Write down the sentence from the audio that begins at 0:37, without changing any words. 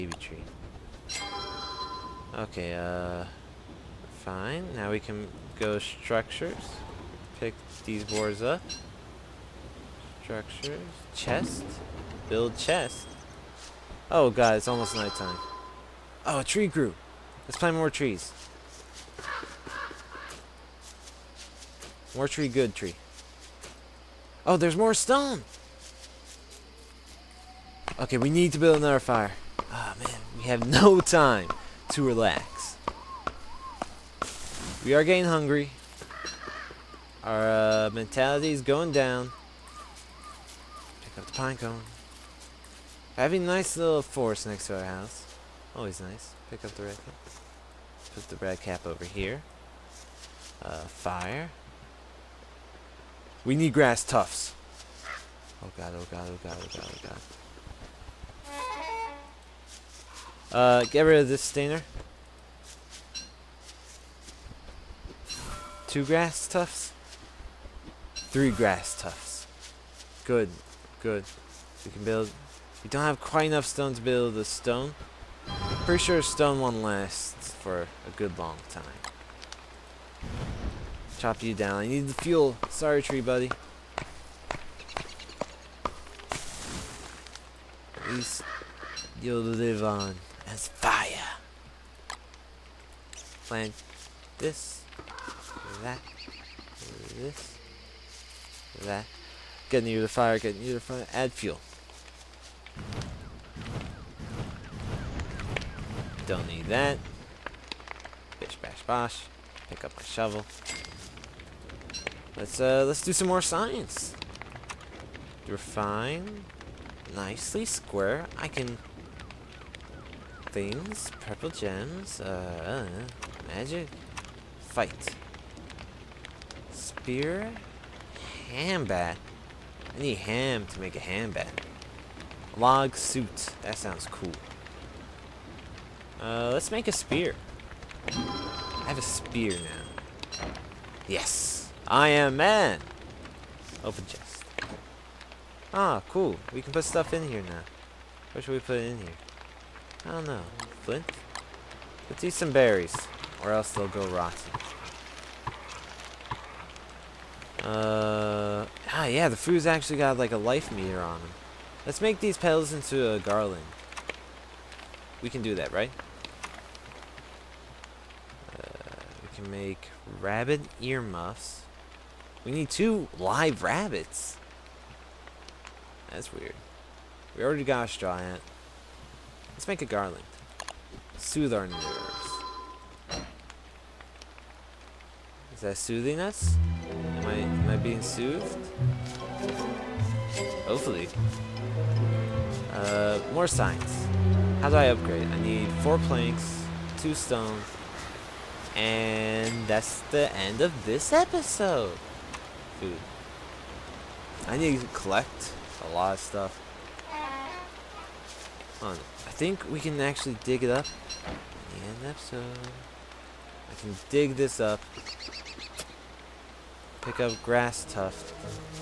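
Our uh, mentality is going down.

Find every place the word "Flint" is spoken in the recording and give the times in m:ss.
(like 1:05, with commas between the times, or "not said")
2:30.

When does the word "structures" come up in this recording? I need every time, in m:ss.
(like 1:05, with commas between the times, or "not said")
0:05, 0:10.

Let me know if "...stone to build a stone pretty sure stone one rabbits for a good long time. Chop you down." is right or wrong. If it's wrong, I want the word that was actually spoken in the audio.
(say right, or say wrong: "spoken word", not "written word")
wrong: "lasts", not "rabbits".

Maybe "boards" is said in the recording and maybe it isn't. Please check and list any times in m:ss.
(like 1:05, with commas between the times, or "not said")
0:08.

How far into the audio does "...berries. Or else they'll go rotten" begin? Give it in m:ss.
2:32.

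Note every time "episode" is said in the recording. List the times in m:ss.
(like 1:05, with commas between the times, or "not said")
3:21, 3:32.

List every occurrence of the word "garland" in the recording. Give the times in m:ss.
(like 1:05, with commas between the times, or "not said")
2:43, 2:59.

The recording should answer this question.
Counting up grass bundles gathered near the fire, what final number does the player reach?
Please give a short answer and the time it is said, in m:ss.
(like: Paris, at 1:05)
3, at 1:08.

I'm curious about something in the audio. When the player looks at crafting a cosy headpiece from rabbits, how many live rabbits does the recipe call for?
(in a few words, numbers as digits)
2.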